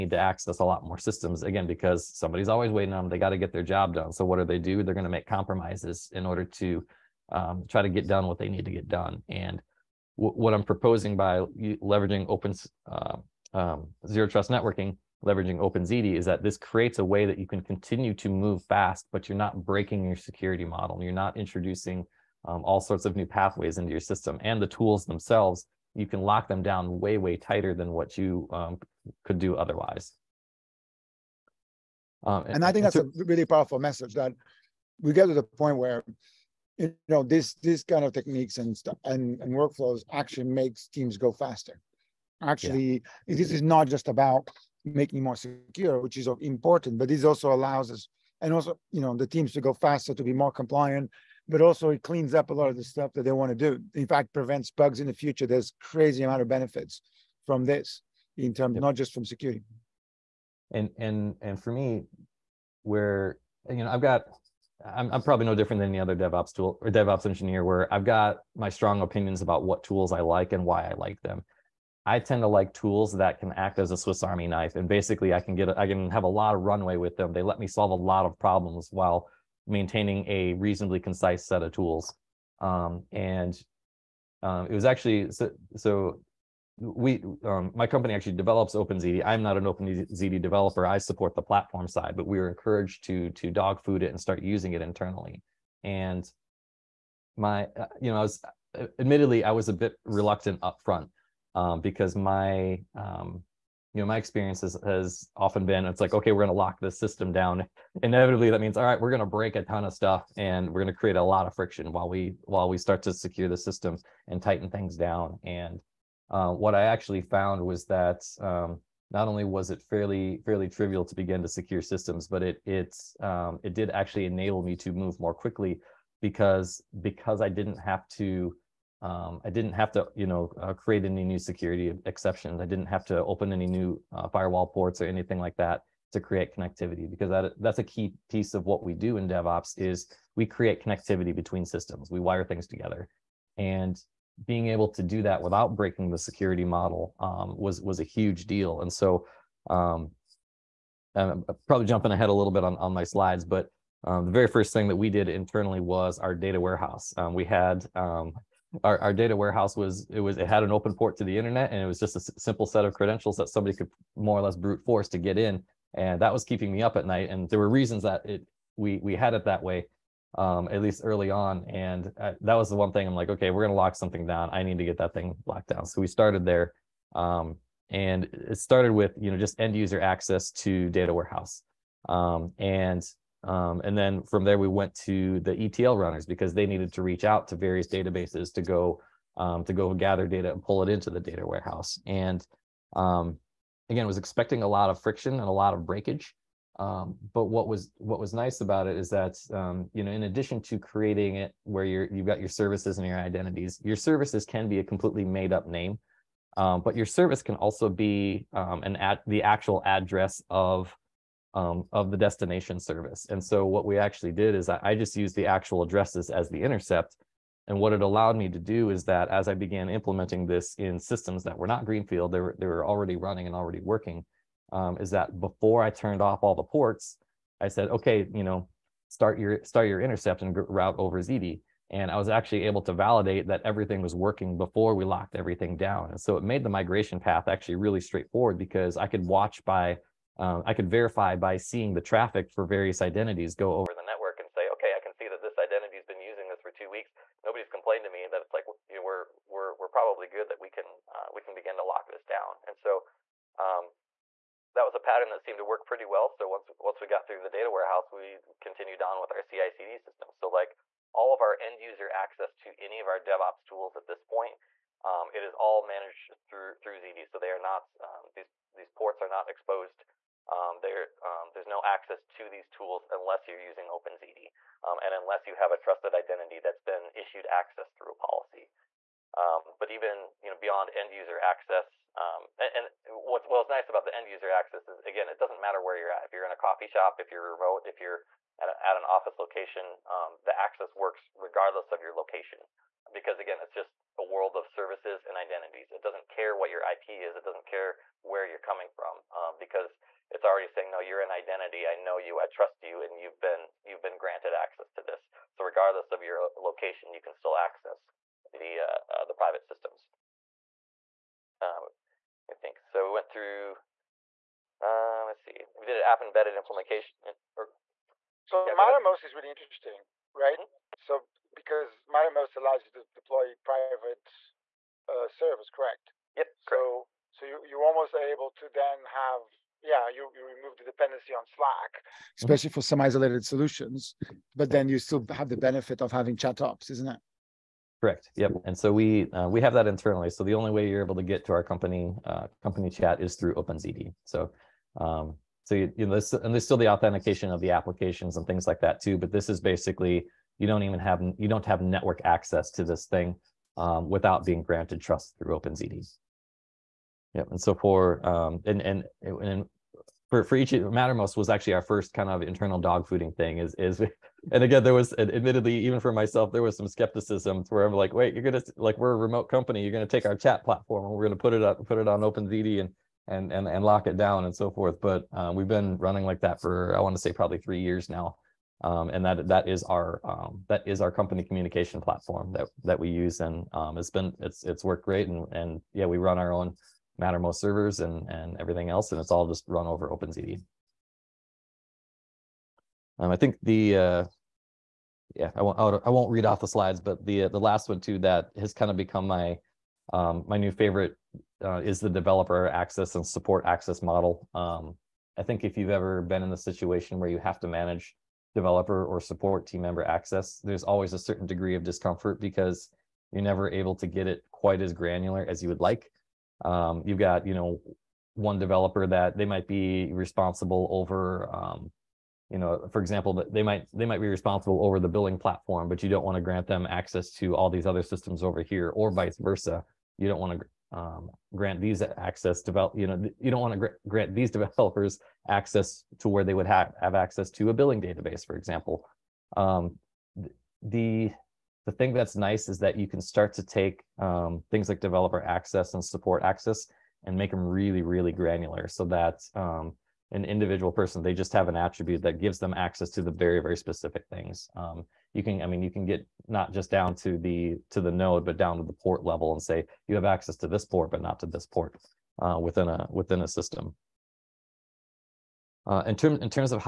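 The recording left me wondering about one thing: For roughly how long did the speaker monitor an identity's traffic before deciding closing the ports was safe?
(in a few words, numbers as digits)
2 weeks.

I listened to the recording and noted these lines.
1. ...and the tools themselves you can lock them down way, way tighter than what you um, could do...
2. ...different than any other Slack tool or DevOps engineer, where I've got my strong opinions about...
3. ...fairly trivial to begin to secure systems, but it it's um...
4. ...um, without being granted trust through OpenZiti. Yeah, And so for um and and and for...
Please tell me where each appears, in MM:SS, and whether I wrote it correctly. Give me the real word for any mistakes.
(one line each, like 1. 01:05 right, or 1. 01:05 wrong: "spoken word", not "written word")
1. 00:24 right
2. 01:05 wrong: "DevOps", not "Slack"
3. 02:00 right
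4. 05:53 right.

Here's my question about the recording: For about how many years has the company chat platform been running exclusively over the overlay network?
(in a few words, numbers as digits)
3 years.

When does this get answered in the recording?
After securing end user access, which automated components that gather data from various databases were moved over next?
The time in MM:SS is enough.
03:05.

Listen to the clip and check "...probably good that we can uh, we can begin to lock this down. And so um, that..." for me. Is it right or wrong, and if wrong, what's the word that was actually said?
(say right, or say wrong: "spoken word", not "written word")
right.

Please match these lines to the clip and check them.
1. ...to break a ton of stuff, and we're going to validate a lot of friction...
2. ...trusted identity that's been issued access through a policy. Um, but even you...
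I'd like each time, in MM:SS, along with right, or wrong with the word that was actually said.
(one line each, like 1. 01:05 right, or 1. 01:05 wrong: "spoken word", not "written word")
1. 01:49 wrong: "create", not "validate"
2. 04:35 right.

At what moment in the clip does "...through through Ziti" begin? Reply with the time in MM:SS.
04:26.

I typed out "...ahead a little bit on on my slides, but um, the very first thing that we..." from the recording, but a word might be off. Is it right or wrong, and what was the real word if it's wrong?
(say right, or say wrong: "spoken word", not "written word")
right.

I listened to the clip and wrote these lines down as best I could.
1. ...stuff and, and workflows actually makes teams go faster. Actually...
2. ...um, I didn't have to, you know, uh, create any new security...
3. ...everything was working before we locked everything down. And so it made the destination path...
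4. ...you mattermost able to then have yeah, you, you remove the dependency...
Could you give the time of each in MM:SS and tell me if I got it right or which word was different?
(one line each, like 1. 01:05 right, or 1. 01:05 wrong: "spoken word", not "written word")
1. 00:38 right
2. 02:09 right
3. 03:53 wrong: "migration", not "destination"
4. 05:27 wrong: "almost", not "mattermost".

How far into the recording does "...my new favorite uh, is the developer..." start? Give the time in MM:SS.
06:40.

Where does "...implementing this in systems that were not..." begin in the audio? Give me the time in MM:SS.
03:39.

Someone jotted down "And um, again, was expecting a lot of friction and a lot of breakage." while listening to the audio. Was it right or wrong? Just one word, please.
right.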